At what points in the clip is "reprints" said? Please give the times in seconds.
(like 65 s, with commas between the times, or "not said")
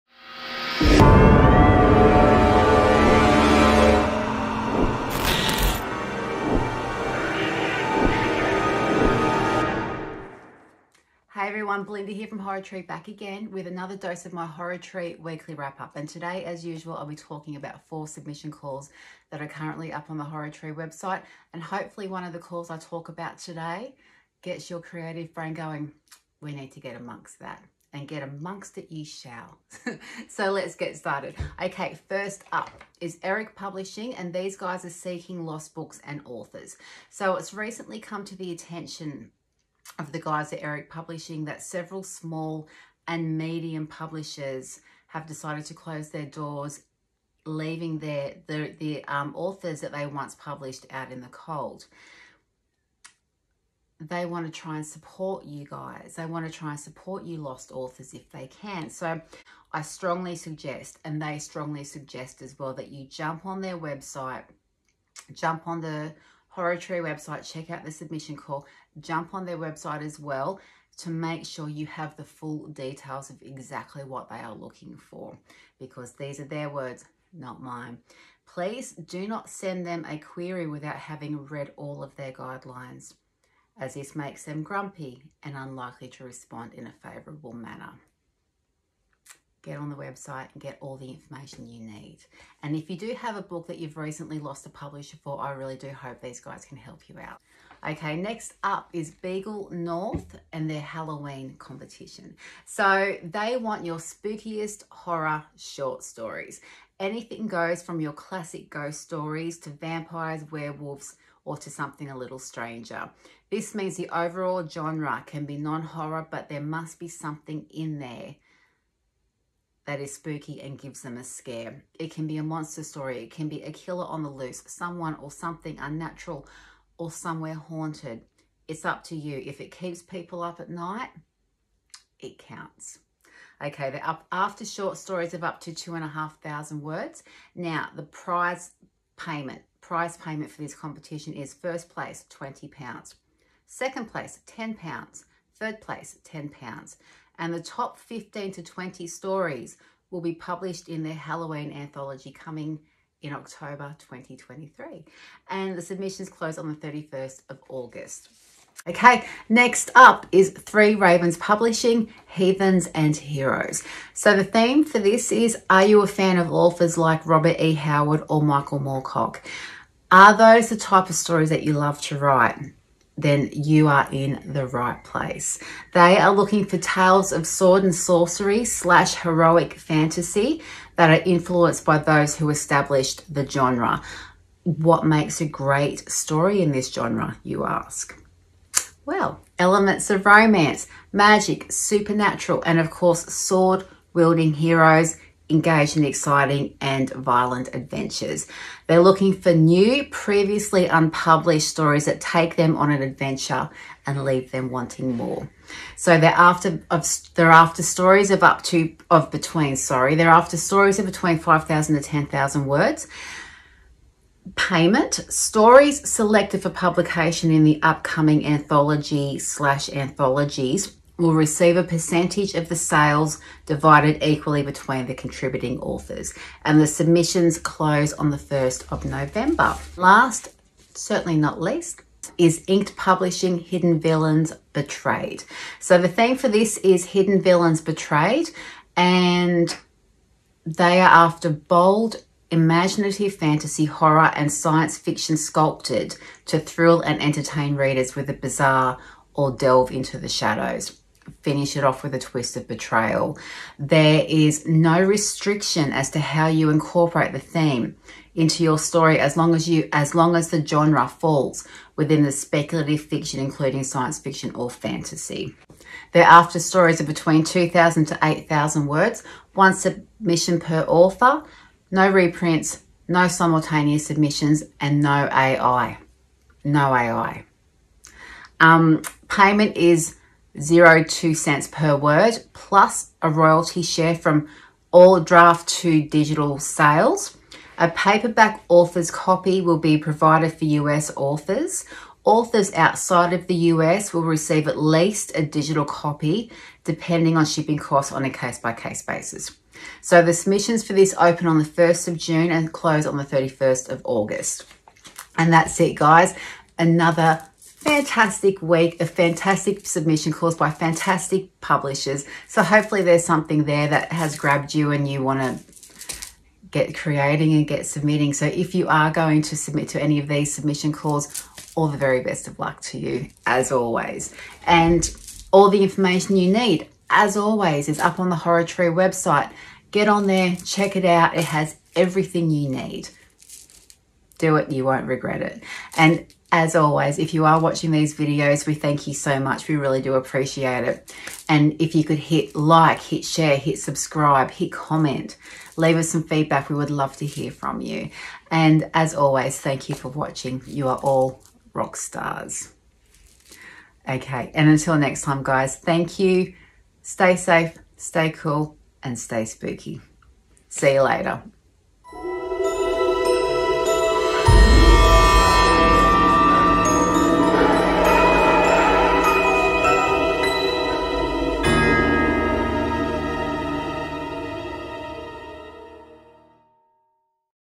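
272 s.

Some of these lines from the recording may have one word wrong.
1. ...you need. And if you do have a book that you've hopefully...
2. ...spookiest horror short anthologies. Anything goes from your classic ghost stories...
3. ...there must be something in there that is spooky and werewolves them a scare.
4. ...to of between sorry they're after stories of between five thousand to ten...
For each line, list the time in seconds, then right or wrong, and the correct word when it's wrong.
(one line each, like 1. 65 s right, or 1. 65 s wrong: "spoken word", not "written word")
1. 91 s wrong: "recently", not "hopefully"
2. 103 s wrong: "stories", not "anthologies"
3. 116 s wrong: "gives", not "werewolves"
4. 208 s right.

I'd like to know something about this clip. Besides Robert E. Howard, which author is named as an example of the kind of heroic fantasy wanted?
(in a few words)
Michael Moorcock.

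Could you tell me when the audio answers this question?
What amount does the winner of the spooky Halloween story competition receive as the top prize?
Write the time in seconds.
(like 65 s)
142 s.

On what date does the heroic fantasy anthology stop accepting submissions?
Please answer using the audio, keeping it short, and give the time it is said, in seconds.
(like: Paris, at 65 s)
1 November, at 228 s.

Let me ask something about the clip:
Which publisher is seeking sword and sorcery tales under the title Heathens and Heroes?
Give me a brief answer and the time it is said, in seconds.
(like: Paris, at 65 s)
Three Ravens Publishing, at 160 s.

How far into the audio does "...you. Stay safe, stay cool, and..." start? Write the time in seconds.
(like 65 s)
356 s.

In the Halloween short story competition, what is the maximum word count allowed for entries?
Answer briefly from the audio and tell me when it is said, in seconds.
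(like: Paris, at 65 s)
2,500 words, at 135 s.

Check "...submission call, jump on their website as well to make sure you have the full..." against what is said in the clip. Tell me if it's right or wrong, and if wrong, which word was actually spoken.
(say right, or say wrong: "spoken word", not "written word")
right.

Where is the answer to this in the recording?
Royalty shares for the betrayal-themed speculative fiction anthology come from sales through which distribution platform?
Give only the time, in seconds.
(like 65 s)
285 s.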